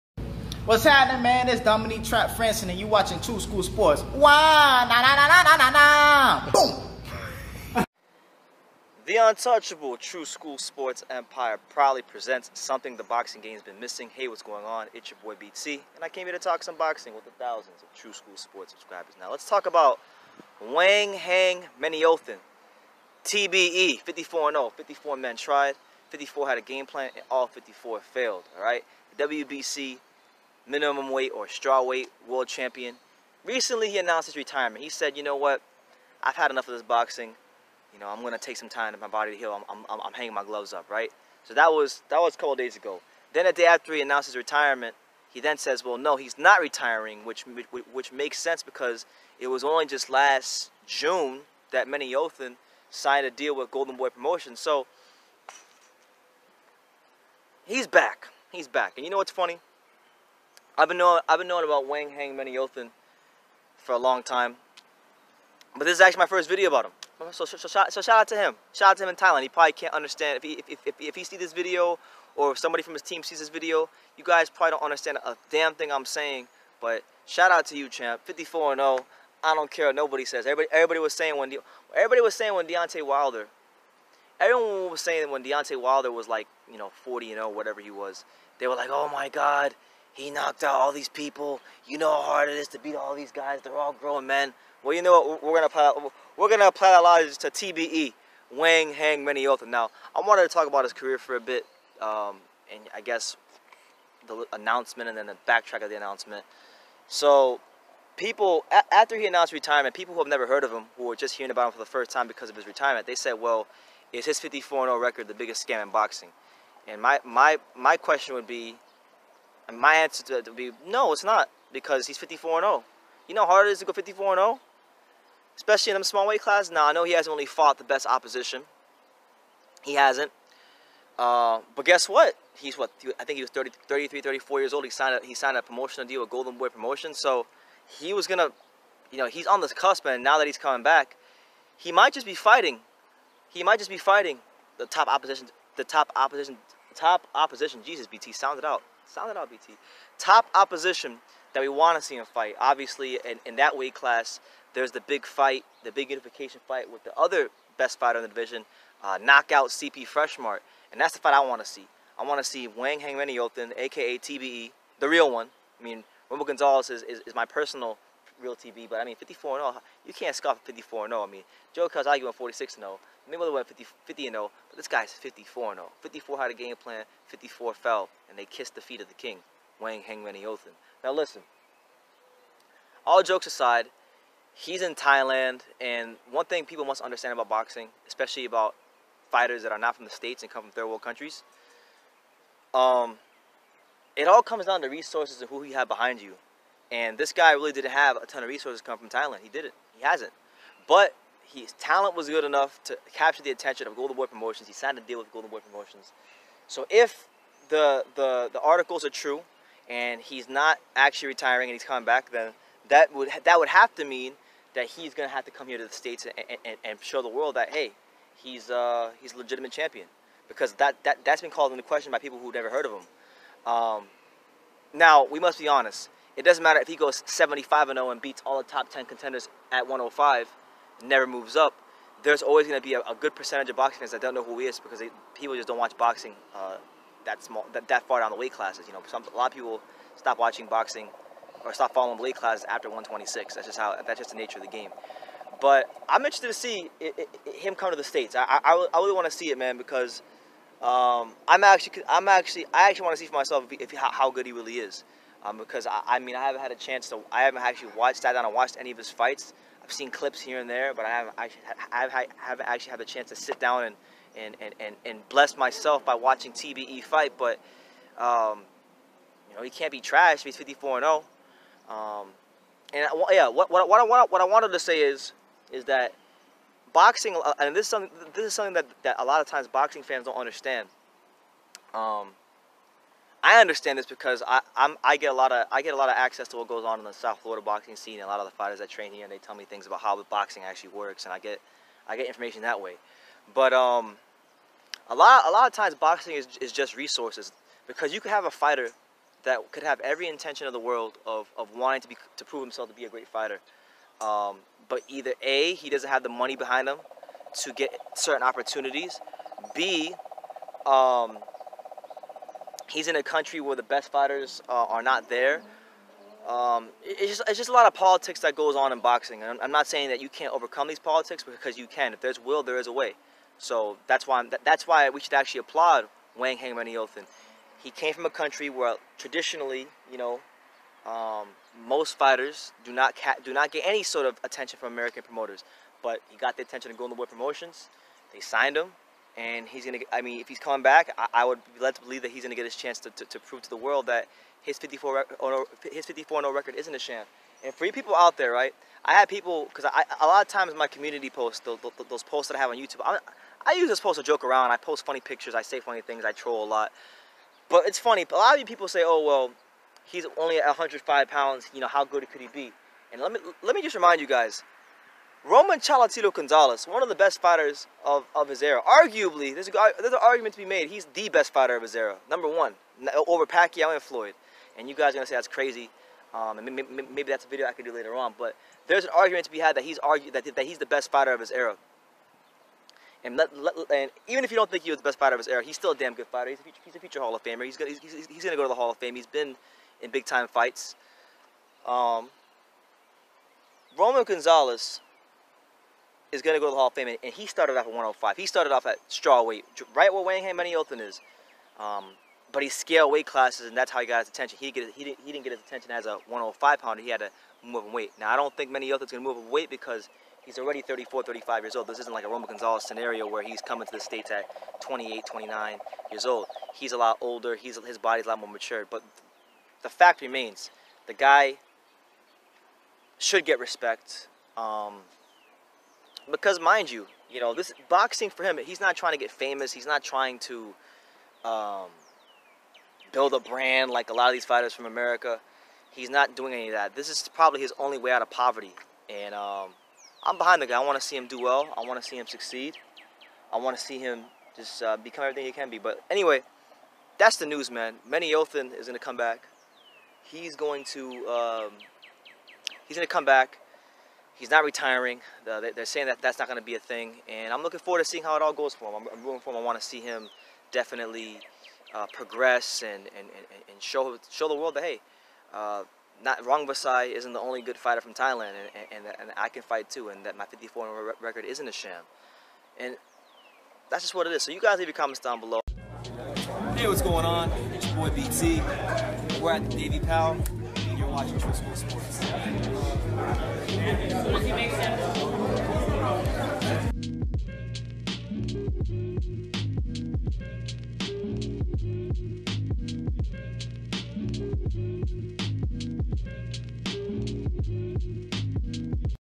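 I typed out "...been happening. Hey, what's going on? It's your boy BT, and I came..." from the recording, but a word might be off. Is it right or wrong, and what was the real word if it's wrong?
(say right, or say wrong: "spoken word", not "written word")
wrong: "missing", not "happening".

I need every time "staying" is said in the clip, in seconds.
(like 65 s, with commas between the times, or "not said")
not said.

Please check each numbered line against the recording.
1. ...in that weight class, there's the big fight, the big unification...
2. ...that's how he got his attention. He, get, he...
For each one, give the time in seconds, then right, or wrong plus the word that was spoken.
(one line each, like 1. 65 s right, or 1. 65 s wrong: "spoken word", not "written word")
1. 153 s right
2. 403 s right.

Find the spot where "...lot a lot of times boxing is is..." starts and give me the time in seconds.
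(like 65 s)
295 s.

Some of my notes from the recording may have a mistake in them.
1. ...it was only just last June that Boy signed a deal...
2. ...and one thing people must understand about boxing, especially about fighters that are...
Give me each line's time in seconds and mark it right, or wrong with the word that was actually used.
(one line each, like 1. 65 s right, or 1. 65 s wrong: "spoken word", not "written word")
1. 49 s wrong: "Menayothin", not "Boy"
2. 185 s right.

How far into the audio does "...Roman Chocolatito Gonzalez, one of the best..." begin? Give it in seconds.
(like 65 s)
365 s.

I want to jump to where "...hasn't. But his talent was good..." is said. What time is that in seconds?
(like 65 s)
200 s.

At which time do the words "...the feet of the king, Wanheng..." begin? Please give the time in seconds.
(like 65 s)
178 s.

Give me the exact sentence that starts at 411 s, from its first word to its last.
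This isn't like a Roman Gonzalez scenario where he's coming to the States at 28, 29 years old.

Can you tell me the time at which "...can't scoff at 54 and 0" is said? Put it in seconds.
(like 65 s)
170 s.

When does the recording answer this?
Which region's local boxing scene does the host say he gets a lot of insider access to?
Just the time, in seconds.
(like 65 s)
287 s.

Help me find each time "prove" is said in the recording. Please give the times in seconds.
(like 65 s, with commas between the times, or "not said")
302 s, 343 s.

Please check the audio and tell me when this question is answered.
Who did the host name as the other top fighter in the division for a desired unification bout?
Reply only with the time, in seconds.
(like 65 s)
159 s.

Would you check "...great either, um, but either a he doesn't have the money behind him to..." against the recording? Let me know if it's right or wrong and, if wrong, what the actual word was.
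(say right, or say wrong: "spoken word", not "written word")
wrong: "fighter", not "either".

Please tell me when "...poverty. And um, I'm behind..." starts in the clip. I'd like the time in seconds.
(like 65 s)
438 s.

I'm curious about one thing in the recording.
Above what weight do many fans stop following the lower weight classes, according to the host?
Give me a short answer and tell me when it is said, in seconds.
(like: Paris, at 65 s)
126, at 242 s.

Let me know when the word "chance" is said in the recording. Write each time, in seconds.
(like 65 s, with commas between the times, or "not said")
256 s, 263 s, 342 s.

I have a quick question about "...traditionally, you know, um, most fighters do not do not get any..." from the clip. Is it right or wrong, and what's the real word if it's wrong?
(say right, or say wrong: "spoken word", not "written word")
right.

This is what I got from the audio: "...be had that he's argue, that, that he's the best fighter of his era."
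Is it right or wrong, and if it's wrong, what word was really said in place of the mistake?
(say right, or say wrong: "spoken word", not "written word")
right.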